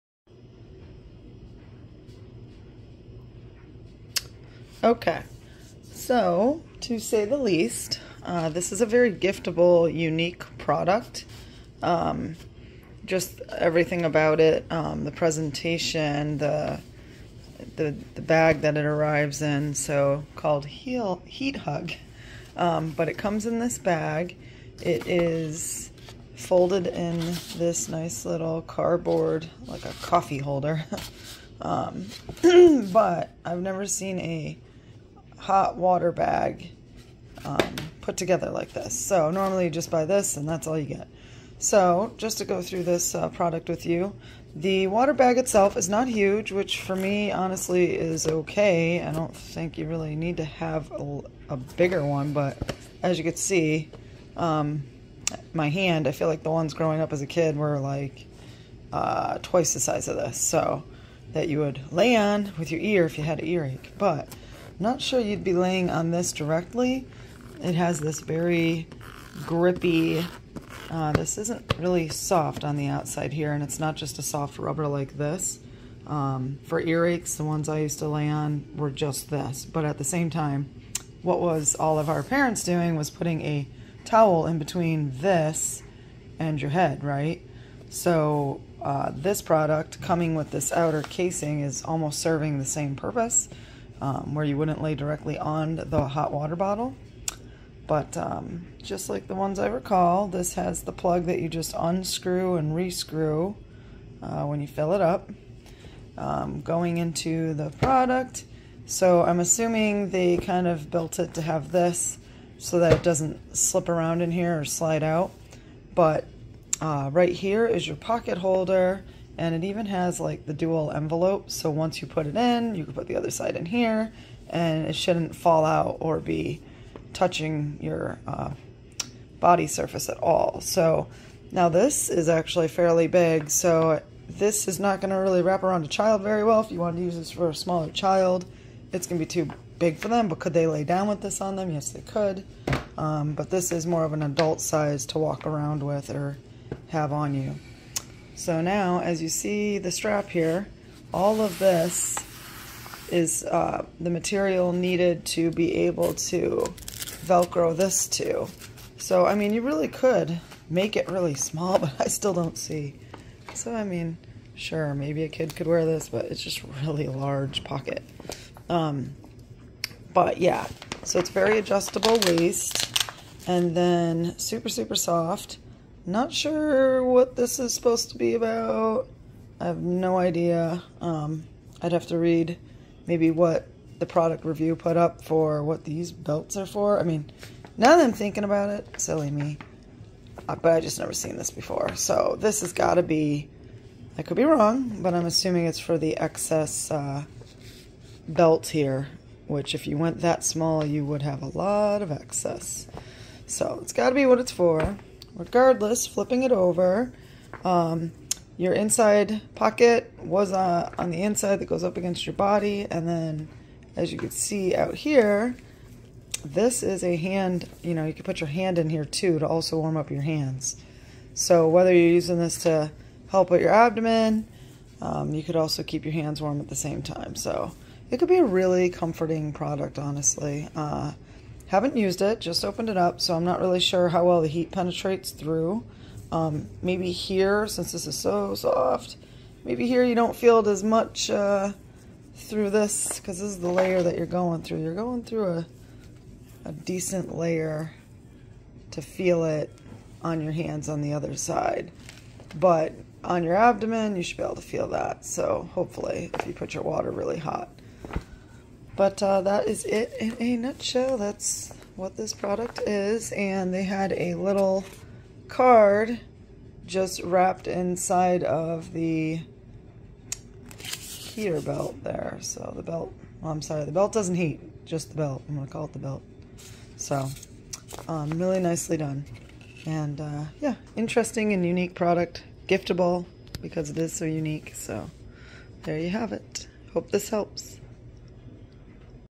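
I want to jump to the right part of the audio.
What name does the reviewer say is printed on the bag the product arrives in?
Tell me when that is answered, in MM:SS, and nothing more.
00:21.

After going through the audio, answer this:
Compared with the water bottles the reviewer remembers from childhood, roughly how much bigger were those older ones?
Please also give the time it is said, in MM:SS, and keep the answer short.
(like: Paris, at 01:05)
twice the size, at 00:59.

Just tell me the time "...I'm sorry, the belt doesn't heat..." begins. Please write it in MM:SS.
04:33.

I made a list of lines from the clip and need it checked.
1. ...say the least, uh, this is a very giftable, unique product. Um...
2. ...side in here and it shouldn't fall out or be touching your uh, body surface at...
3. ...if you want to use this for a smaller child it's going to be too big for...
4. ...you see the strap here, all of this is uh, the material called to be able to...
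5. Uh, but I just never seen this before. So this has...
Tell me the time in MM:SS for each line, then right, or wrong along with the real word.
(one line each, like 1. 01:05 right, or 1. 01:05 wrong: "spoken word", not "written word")
1. 00:06 right
2. 02:03 right
3. 02:16 right
4. 02:29 wrong: "needed", not "called"
5. 03:10 right.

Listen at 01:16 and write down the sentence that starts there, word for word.
Um, for earaches, the ones I used to lay on were just this.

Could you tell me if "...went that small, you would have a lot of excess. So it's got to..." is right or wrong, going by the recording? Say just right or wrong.
right.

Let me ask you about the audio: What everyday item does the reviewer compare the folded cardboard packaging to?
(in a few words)
a coffee holder.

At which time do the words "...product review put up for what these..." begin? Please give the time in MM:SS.
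03:04.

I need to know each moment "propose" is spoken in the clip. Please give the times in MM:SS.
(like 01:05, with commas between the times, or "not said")
not said.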